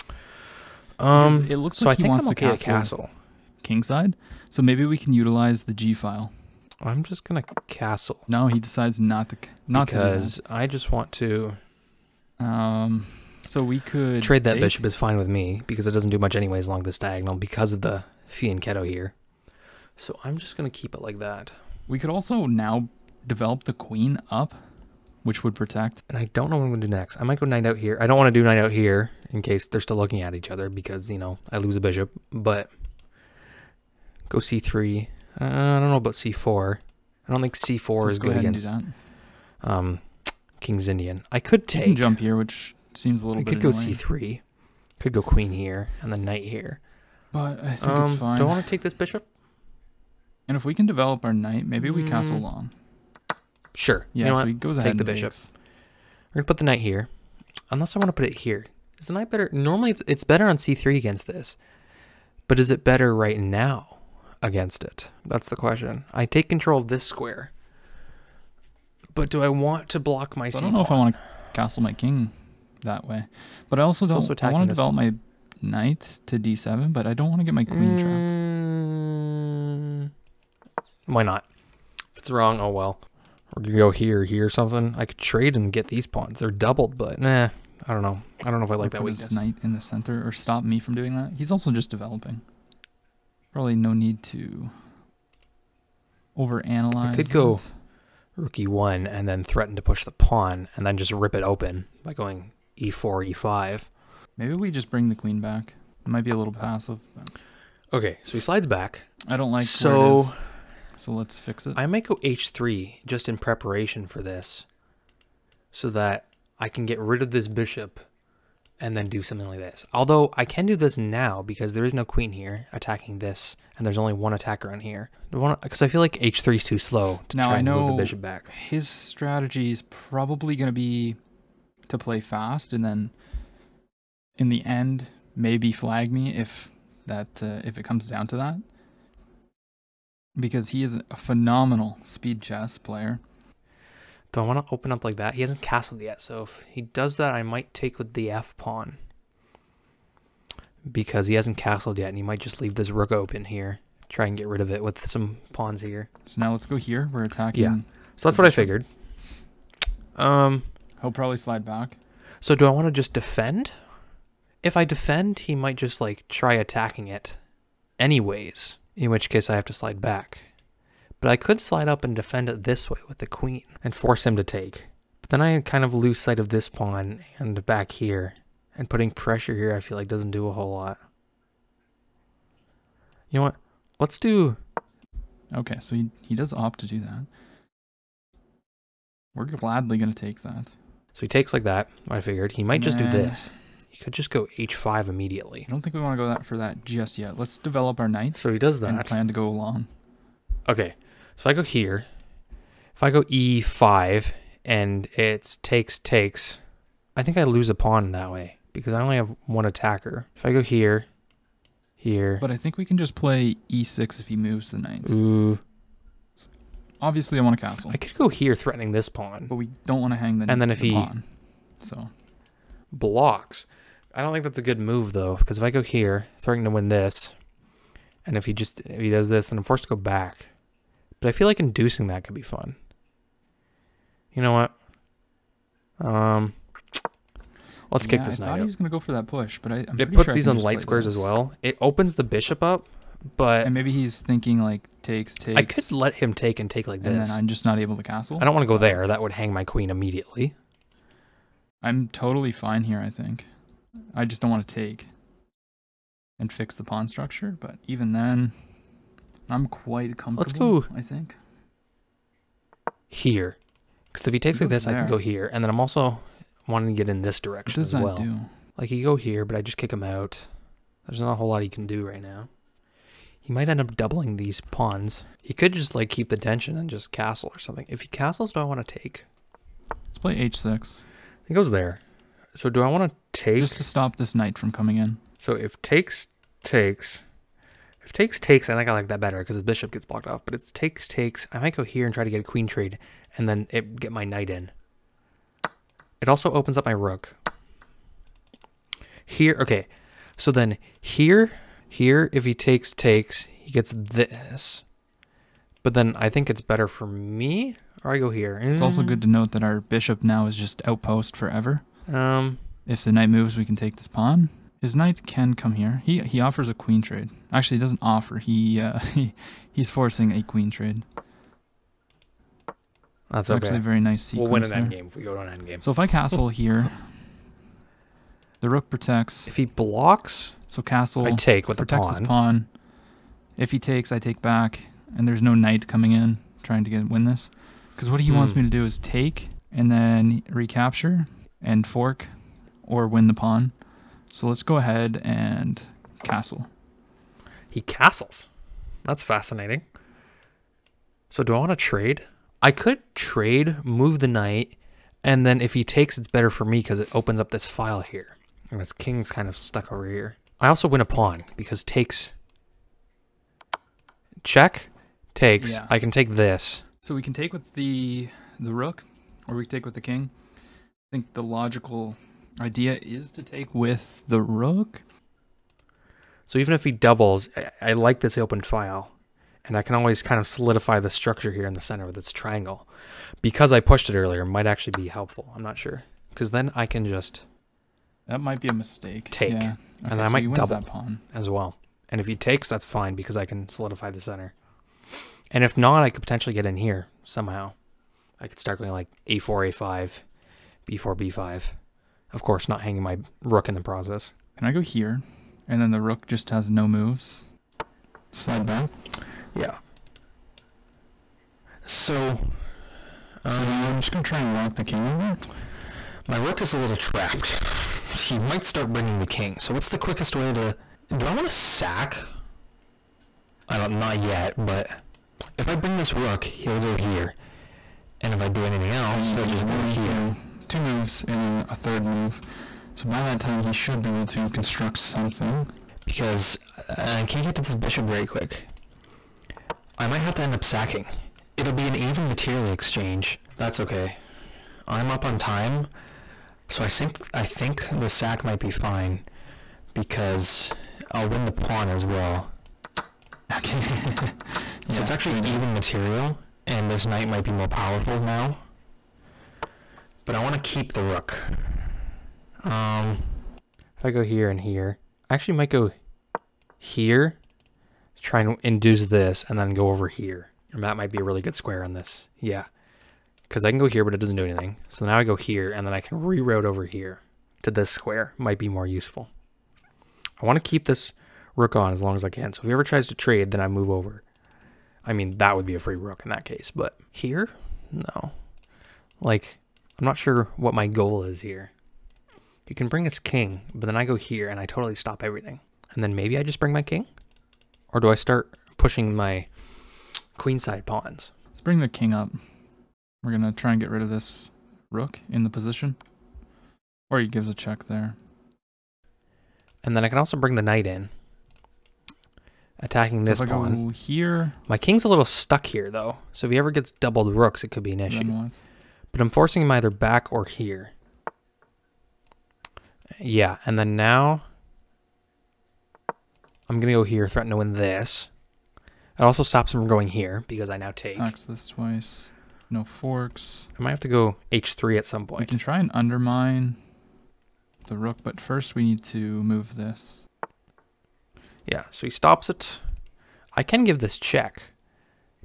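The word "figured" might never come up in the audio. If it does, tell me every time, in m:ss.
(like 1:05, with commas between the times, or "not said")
2:38, 3:12.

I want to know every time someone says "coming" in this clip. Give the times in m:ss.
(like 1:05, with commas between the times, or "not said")
4:44, 5:35.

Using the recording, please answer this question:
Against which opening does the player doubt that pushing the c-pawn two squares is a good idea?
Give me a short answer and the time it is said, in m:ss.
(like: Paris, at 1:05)
King's Indian, at 0:40.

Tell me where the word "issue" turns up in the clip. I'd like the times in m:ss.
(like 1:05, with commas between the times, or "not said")
8:37.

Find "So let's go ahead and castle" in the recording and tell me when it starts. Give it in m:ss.
5:44.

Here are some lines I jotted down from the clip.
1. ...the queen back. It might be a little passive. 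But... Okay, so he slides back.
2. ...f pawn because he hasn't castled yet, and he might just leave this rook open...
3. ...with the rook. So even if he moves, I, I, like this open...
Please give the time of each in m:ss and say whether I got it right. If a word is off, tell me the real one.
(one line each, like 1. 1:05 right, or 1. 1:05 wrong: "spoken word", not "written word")
1. 1:45 right
2. 2:28 right
3. 6:13 wrong: "doubles", not "moves".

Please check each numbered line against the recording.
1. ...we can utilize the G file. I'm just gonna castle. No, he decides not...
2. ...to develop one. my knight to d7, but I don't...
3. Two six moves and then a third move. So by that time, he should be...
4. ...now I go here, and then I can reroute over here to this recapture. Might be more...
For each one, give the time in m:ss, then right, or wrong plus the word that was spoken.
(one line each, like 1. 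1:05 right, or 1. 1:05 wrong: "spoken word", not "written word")
1. 0:04 right
2. 1:14 right
3. 7:10 wrong: "two", not "six"
4. 7:55 wrong: "square", not "recapture".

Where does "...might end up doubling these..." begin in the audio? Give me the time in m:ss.
4:33.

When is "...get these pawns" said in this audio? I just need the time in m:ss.
1:25.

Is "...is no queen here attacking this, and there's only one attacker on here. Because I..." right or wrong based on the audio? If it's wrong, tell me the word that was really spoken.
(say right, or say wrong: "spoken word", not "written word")
right.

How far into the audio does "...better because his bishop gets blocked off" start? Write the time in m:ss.
4:49.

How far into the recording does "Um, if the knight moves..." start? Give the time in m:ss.
5:12.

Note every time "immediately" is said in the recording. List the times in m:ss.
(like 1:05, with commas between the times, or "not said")
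3:15, 4:09.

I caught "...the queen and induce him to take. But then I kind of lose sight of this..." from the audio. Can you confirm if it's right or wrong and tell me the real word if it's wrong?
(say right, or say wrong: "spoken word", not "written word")
wrong: "force", not "induce".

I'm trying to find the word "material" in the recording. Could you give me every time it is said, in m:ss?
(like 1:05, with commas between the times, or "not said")
7:22, 7:35.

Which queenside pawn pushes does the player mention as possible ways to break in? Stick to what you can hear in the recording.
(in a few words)
a4, a5, b4, b5.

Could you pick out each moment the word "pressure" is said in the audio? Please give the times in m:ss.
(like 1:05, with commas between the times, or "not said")
2:59.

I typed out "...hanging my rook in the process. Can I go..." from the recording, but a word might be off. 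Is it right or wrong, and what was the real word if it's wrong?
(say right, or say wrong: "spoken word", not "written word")
right.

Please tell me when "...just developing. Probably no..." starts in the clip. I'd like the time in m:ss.
1:31.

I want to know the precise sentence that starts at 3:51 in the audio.
But I feel like inducing that could be fun.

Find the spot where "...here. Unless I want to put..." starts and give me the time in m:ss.
0:56.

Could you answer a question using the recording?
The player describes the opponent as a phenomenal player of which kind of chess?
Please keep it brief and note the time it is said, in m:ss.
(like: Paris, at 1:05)
speed chess, at 2:22.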